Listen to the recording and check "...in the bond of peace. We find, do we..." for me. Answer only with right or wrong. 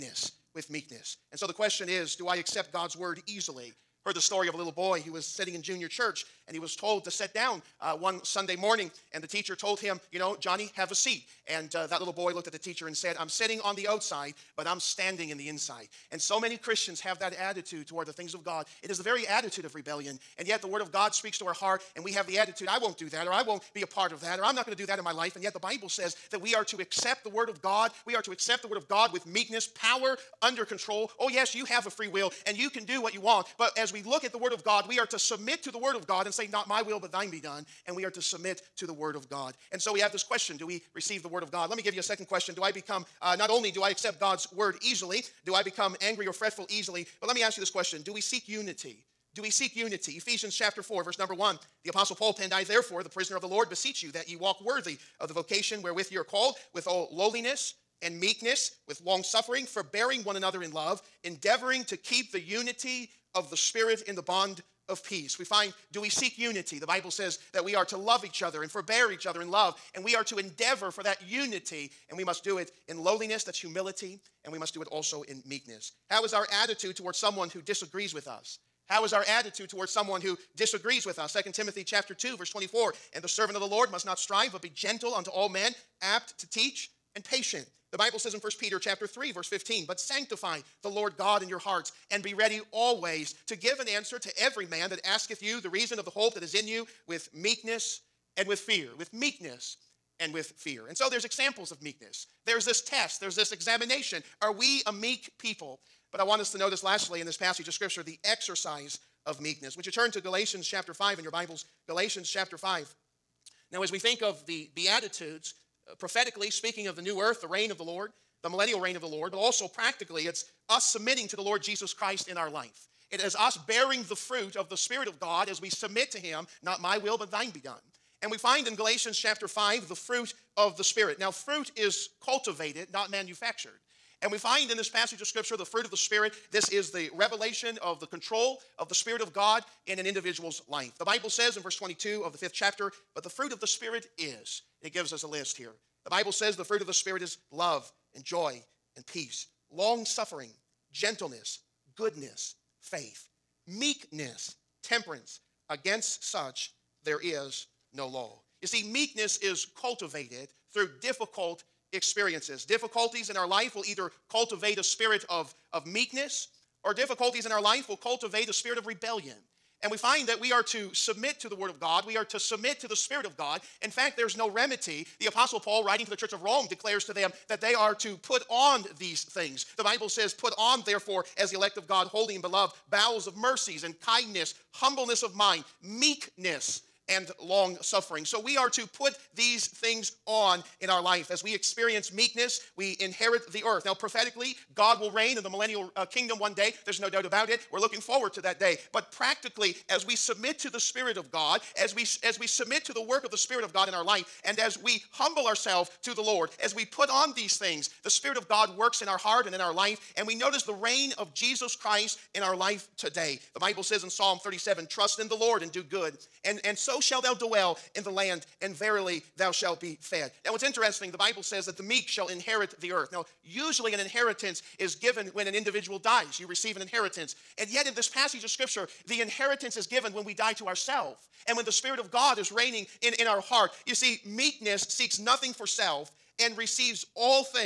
right.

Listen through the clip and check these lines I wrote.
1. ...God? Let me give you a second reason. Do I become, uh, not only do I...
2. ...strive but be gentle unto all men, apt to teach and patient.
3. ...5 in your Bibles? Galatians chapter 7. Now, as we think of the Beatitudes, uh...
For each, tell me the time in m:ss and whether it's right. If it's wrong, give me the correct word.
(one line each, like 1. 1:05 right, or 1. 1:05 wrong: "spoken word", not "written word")
1. 0:41 wrong: "question", not "reason"
2. 1:24 right
3. 1:50 wrong: "5", not "7".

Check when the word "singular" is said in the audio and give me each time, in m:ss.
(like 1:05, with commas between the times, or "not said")
not said.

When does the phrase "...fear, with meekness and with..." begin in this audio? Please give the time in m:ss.
1:38.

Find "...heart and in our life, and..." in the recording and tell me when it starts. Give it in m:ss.
3:29.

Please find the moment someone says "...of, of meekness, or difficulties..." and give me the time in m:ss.
2:45.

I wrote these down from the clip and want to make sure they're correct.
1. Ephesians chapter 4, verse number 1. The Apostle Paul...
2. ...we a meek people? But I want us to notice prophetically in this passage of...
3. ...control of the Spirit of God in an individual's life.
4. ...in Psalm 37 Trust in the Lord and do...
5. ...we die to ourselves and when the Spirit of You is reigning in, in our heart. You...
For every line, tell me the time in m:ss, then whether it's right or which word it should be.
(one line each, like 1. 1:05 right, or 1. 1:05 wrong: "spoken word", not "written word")
1. 0:50 right
2. 1:44 wrong: "lastly", not "prophetically"
3. 2:18 right
4. 3:34 right
5. 3:50 wrong: "God", not "You".